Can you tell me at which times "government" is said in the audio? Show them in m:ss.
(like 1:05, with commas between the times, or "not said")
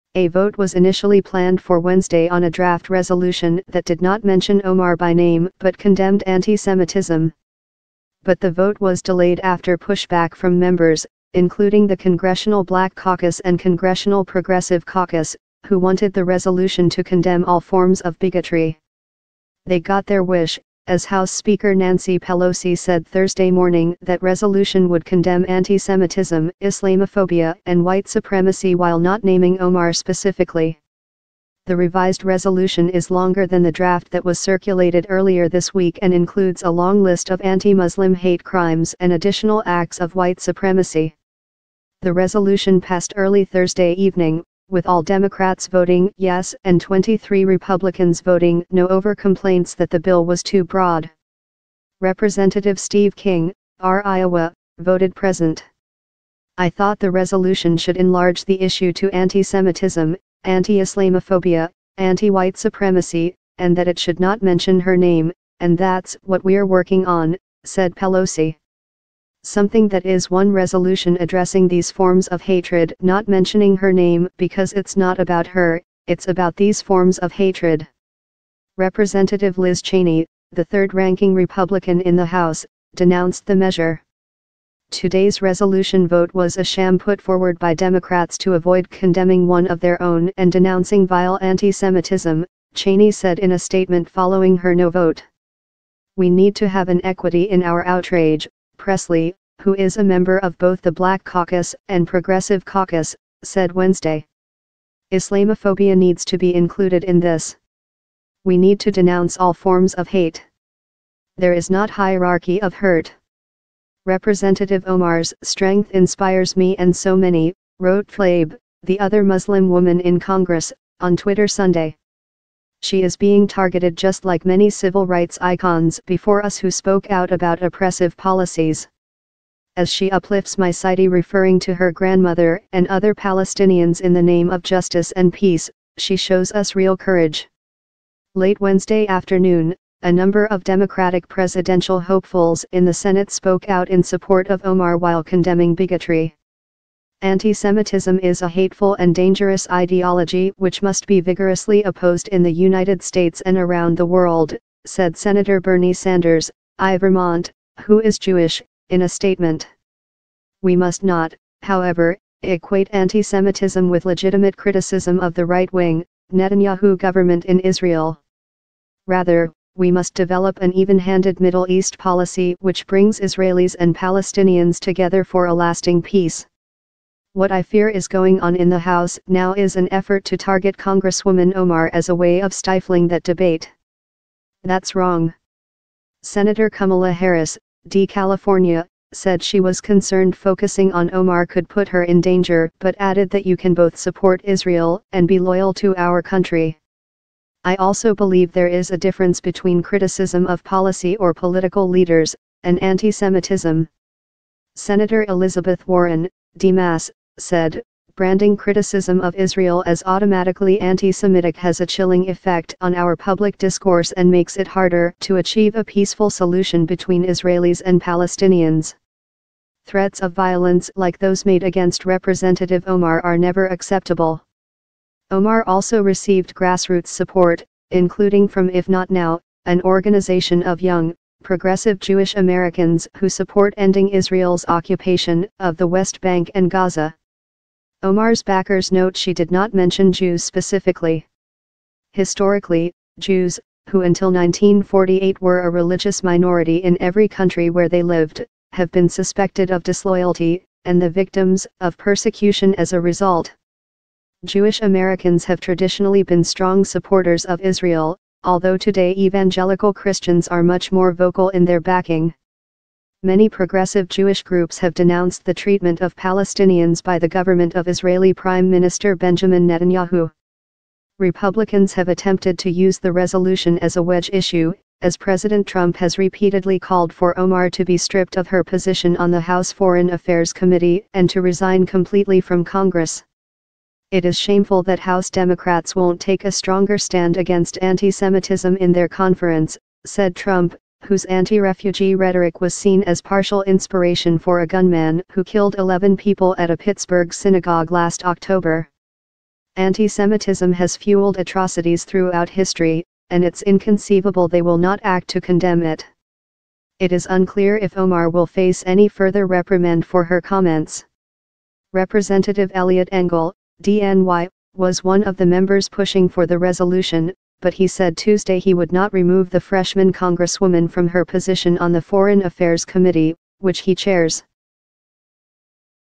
2:46, 4:27.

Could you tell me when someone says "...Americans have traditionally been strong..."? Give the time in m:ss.
4:14.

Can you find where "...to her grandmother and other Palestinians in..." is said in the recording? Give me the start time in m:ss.
2:11.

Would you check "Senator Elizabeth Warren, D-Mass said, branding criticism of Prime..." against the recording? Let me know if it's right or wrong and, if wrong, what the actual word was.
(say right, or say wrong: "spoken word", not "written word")
wrong: "Israel", not "Prime".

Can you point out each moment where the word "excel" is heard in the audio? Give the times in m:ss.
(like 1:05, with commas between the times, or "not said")
not said.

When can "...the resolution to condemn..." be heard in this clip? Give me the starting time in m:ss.
0:16.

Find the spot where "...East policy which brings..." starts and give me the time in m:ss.
2:51.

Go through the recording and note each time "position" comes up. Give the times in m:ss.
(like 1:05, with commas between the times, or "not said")
4:38, 5:21.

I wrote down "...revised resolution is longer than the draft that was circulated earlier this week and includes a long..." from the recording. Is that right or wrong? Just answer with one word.
right.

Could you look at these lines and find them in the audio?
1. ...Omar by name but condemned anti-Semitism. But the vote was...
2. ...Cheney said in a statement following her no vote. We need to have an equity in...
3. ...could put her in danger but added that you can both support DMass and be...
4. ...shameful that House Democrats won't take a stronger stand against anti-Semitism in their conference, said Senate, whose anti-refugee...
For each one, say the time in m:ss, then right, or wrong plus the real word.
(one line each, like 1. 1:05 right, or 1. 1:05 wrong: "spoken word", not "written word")
1. 0:04 right
2. 1:32 right
3. 3:11 wrong: "Israel", not "DMass"
4. 4:44 wrong: "Trump", not "Senate".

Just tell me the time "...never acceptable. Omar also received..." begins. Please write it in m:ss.
3:43.